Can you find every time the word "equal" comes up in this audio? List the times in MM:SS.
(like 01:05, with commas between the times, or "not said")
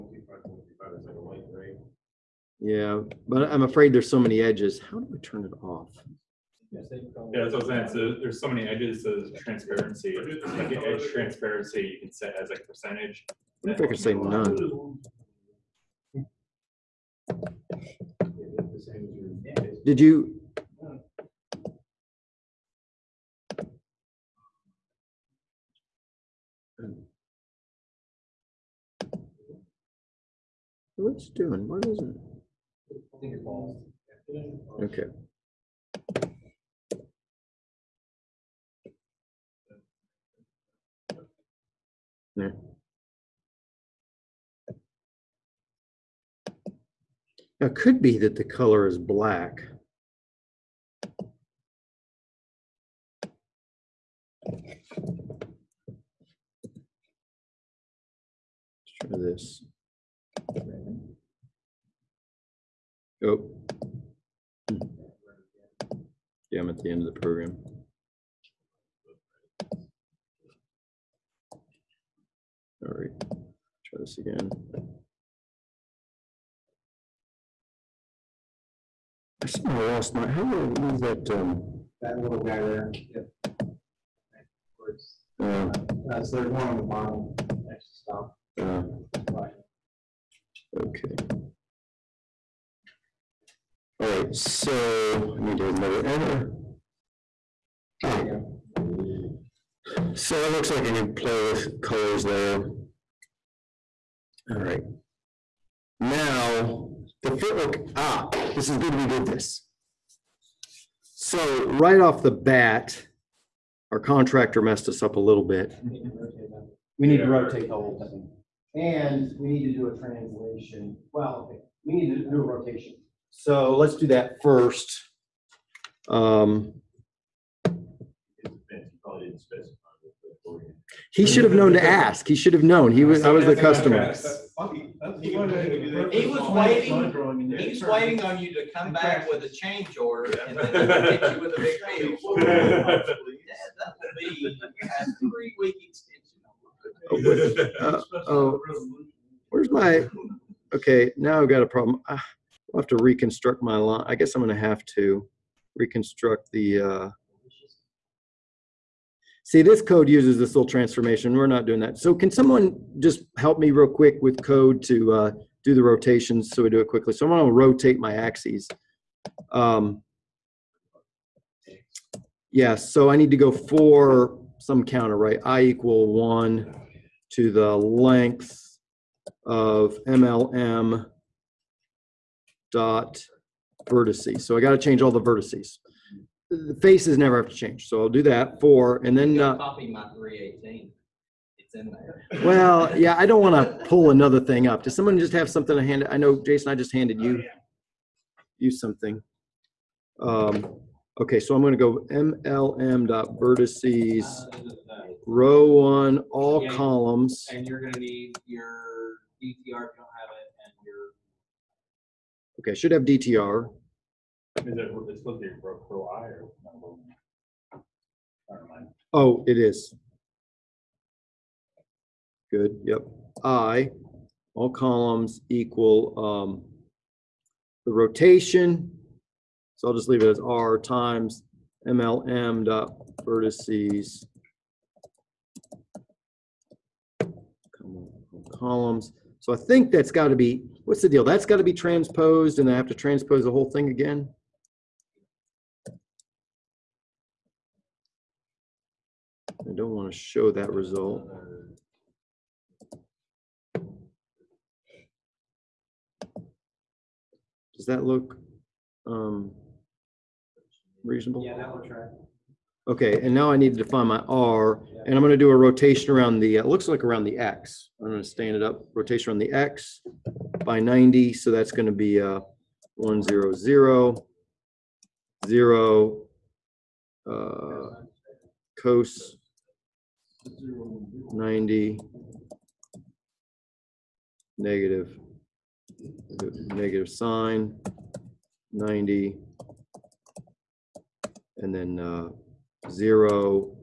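02:55, 03:45.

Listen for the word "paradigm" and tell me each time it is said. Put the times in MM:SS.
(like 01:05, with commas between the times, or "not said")
not said.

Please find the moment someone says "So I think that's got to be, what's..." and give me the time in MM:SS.
03:59.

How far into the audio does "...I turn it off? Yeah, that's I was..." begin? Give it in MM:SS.
00:05.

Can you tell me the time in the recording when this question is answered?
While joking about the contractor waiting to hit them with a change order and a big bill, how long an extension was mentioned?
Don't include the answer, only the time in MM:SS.
02:25.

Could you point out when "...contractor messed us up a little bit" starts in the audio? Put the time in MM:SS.
01:53.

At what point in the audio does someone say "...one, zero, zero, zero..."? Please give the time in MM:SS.
04:32.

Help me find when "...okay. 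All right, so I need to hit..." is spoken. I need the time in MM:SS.
01:30.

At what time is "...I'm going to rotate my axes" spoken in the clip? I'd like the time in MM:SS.
02:47.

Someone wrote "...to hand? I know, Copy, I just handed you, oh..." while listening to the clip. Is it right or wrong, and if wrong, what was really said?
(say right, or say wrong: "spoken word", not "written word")
wrong: "Jason", not "Copy".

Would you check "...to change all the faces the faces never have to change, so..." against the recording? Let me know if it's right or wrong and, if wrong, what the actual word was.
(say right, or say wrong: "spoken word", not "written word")
wrong: "vertices", not "faces".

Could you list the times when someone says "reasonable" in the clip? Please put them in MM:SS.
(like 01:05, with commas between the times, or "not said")
04:21.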